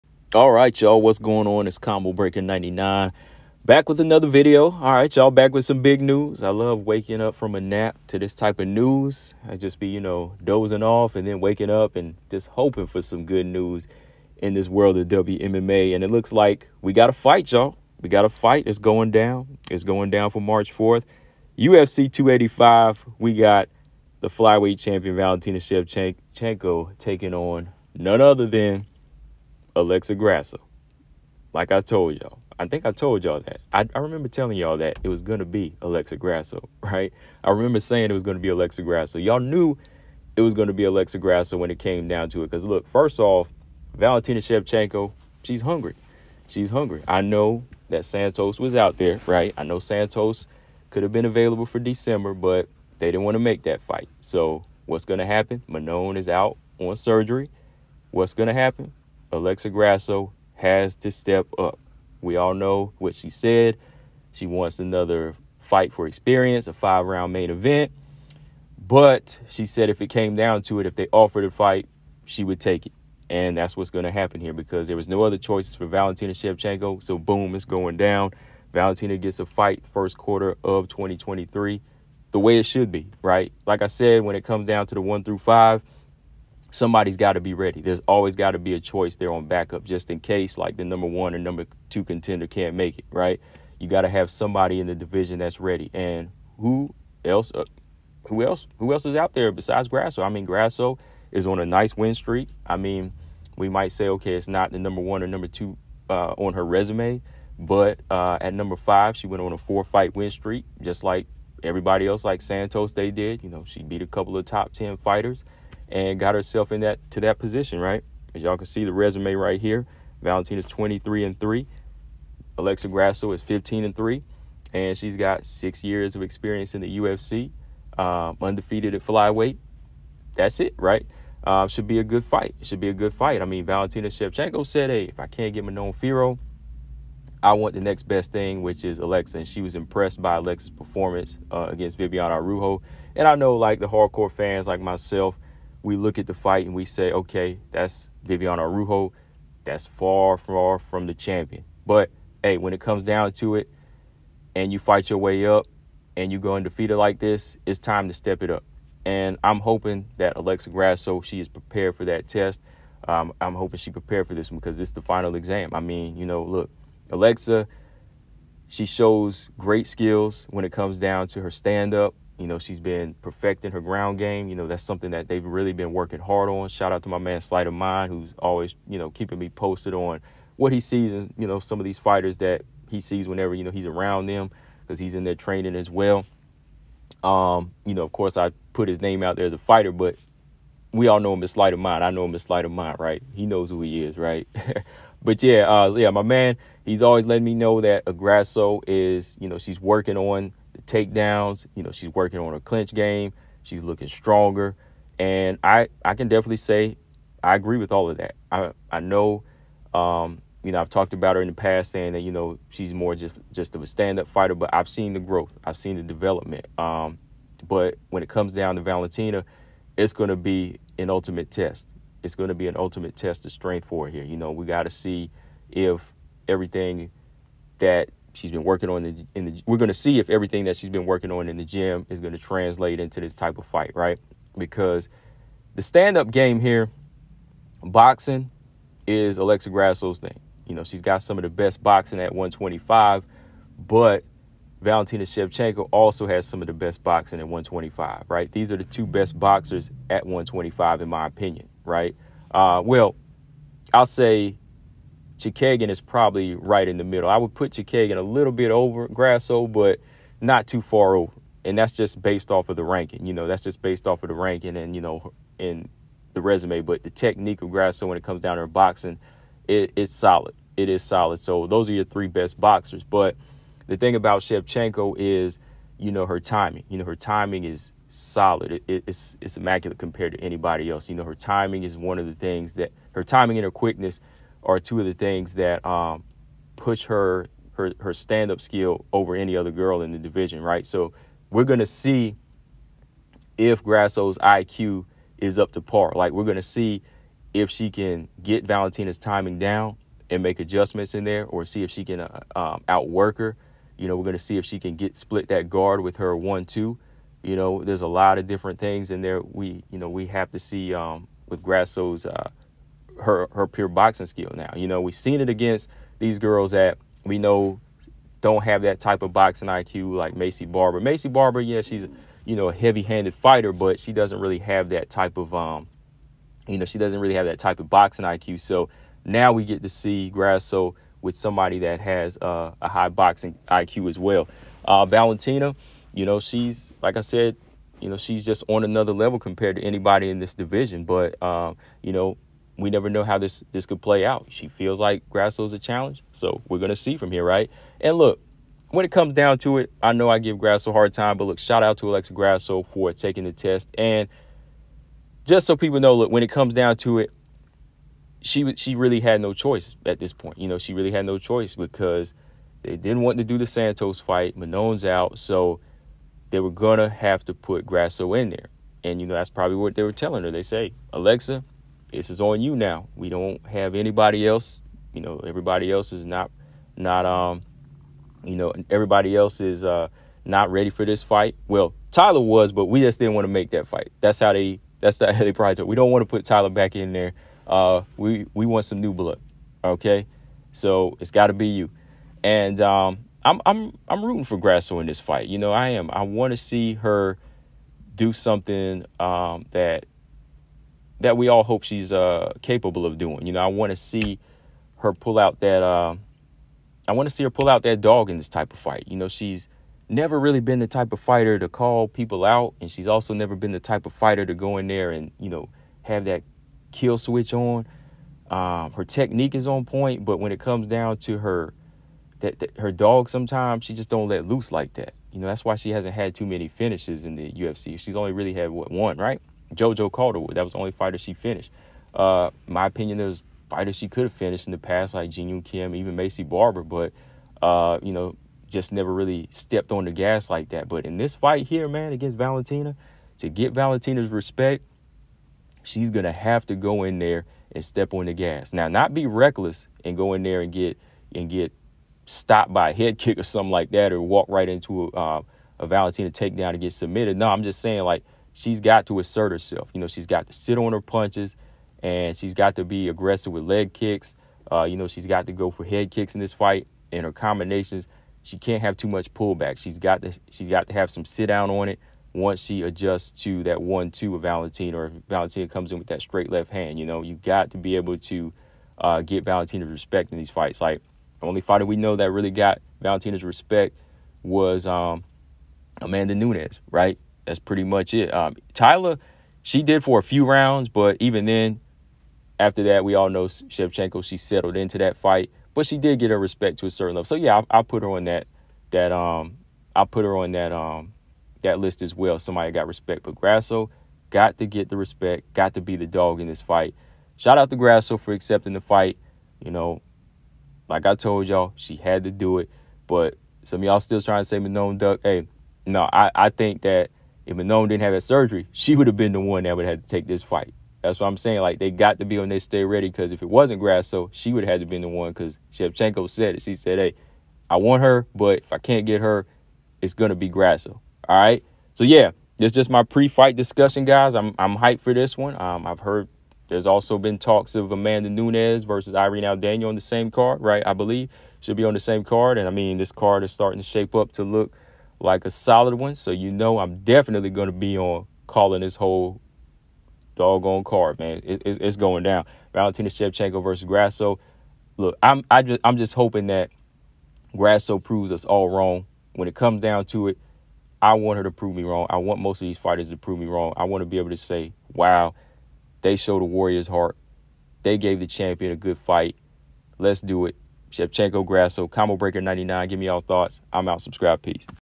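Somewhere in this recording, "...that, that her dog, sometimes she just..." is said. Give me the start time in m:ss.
7:02.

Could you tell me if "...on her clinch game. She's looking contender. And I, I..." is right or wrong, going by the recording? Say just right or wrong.
wrong.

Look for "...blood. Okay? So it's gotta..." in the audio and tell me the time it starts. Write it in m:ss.
6:29.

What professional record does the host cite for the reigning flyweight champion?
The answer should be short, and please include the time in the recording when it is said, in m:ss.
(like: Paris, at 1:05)
23 and 3, at 2:00.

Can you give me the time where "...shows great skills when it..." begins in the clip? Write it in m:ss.
2:48.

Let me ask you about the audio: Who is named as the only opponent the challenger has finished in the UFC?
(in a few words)
JoJo Calderwood.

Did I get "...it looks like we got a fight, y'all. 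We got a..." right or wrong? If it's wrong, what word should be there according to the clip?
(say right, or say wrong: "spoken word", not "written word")
right.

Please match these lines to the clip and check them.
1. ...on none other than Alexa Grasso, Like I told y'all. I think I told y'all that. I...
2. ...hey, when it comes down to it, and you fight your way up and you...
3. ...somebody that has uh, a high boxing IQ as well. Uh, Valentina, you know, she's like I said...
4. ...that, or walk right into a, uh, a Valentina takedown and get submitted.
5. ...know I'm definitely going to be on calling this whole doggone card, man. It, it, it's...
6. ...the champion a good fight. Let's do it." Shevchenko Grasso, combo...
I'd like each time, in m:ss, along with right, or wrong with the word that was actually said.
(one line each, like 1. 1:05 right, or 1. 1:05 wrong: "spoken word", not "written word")
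1. 0:27 right
2. 2:32 right
3. 5:31 right
4. 7:33 right
5. 9:06 right
6. 9:28 right.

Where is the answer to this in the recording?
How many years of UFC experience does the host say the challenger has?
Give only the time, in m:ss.
2:05.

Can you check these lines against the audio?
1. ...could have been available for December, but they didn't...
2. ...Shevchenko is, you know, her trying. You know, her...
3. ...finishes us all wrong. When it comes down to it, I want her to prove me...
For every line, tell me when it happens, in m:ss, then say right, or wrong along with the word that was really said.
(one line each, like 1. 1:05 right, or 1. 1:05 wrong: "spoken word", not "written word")
1. 0:50 right
2. 4:34 wrong: "timing", not "trying"
3. 9:17 wrong: "proves", not "finishes".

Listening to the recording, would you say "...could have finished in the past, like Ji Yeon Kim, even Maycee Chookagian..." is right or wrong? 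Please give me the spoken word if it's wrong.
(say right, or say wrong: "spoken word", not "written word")
wrong: "Barber", not "Chookagian".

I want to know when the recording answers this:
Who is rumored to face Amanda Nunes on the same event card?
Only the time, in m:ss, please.
8:59.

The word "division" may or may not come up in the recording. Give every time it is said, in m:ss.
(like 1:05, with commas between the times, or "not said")
1:34, 4:50, 5:40.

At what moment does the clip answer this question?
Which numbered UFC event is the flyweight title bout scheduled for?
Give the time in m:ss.
0:21.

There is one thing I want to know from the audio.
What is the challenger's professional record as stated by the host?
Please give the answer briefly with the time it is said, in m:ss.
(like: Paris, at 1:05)
15 and 3, at 2:03.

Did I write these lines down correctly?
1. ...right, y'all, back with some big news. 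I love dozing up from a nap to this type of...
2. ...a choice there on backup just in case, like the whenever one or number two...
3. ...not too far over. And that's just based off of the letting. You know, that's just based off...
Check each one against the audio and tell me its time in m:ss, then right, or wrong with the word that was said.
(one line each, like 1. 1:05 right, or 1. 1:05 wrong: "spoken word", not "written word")
1. 0:04 wrong: "waking", not "dozing"
2. 1:28 wrong: "number", not "whenever"
3. 4:20 wrong: "ranking", not "letting".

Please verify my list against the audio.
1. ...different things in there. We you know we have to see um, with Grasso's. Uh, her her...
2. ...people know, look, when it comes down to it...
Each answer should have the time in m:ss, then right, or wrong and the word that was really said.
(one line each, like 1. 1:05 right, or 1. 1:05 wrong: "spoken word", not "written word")
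1. 5:08 right
2. 5:55 right.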